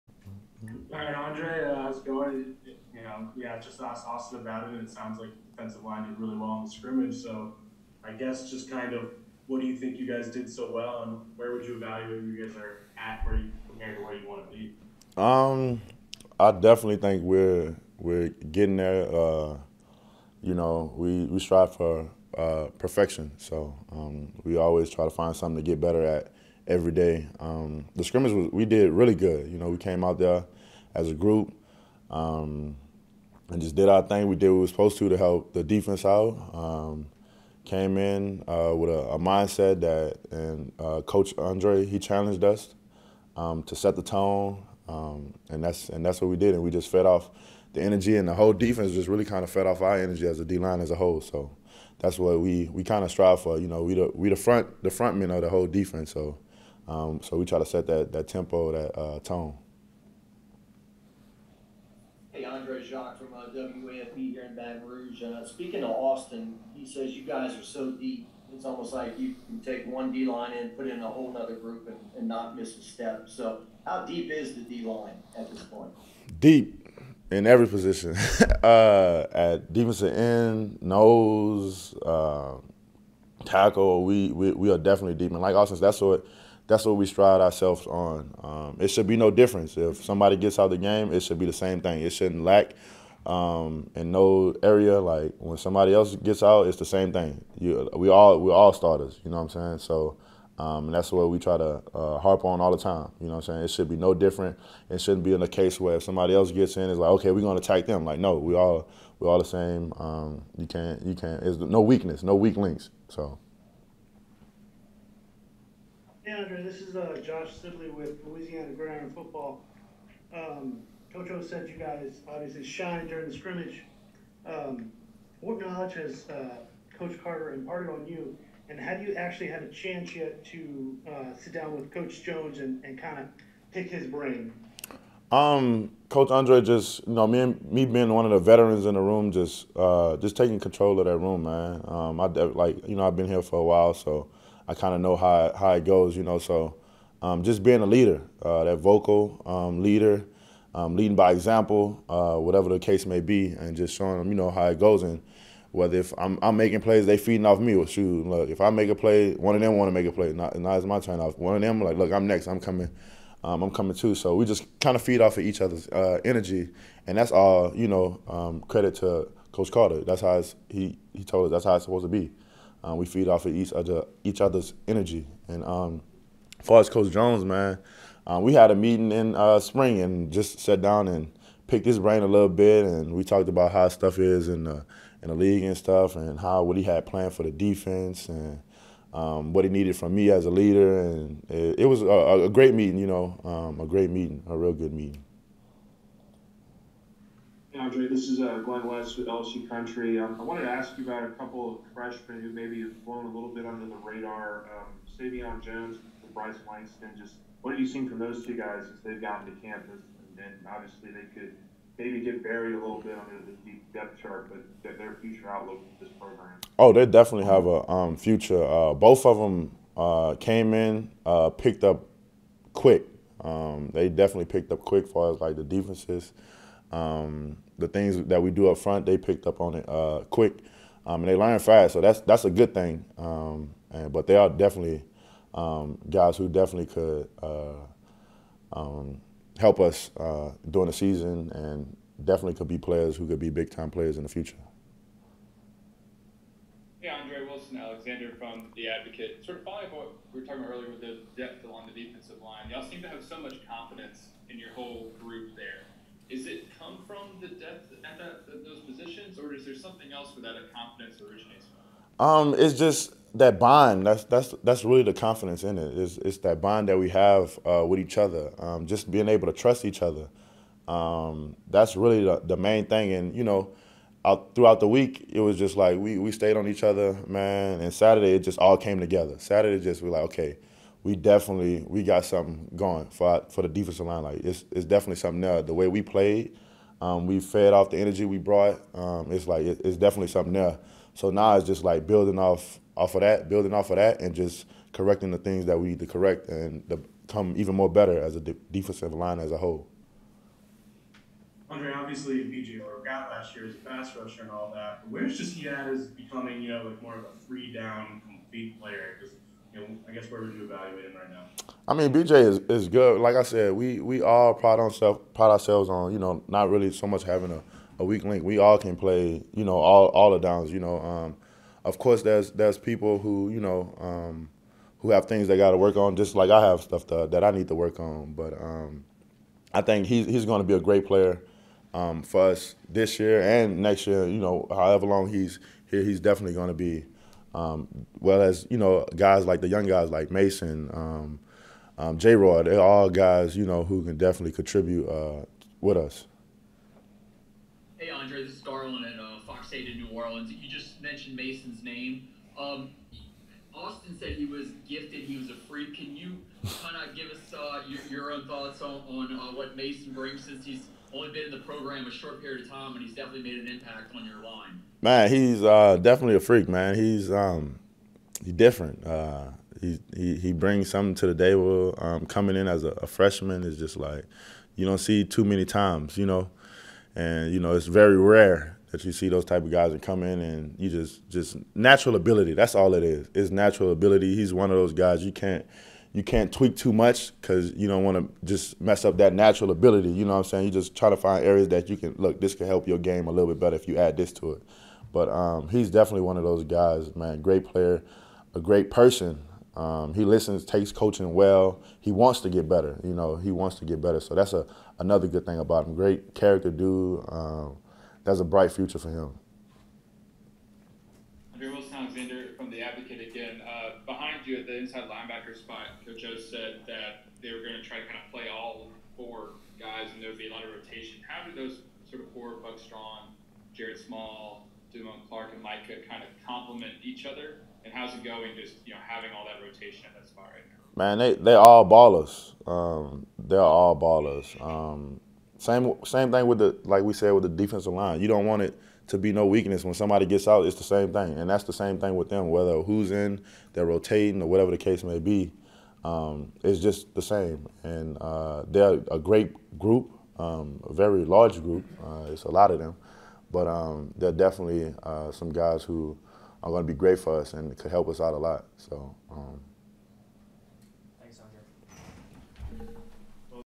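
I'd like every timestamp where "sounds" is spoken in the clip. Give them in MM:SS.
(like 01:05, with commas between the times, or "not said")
00:04.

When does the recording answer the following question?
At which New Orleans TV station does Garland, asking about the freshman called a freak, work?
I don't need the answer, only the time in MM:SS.
05:49.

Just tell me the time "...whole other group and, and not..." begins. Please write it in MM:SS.
01:11.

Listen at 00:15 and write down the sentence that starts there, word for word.
Um, I definitely think we're we're getting there.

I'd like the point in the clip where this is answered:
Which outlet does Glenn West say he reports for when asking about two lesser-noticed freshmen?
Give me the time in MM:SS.
03:19.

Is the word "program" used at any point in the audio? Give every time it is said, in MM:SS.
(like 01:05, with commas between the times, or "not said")
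03:36, 06:01.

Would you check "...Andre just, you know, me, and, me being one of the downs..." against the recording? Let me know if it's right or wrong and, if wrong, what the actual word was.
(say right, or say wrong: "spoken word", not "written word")
wrong: "veterans", not "downs".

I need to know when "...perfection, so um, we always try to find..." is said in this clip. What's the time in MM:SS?
00:22.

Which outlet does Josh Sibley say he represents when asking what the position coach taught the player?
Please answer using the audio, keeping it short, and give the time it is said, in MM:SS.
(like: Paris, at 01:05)
Louisiana Gridiron Football, at 01:58.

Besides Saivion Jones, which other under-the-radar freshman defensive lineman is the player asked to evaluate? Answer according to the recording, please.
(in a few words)
Bryce Langston.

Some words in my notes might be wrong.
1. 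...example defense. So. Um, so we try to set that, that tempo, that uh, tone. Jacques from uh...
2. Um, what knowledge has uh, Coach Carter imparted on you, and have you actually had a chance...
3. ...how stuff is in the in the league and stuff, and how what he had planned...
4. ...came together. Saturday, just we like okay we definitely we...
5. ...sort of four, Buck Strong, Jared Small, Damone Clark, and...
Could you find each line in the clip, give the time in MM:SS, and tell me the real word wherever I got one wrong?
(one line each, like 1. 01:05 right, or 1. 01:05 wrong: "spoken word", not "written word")
1. 00:55 wrong: "whole", not "example"
2. 02:04 right
3. 03:03 right
4. 04:38 right
5. 07:02 right.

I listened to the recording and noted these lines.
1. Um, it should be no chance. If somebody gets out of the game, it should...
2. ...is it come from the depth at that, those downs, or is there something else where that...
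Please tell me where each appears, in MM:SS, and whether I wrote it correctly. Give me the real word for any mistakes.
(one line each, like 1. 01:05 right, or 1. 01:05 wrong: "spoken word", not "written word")
1. 01:28 wrong: "difference", not "chance"
2. 04:16 wrong: "positions", not "downs".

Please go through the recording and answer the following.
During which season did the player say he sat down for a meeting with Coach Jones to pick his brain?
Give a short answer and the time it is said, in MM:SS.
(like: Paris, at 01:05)
spring, at 02:59.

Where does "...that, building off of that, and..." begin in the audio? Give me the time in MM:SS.
04:53.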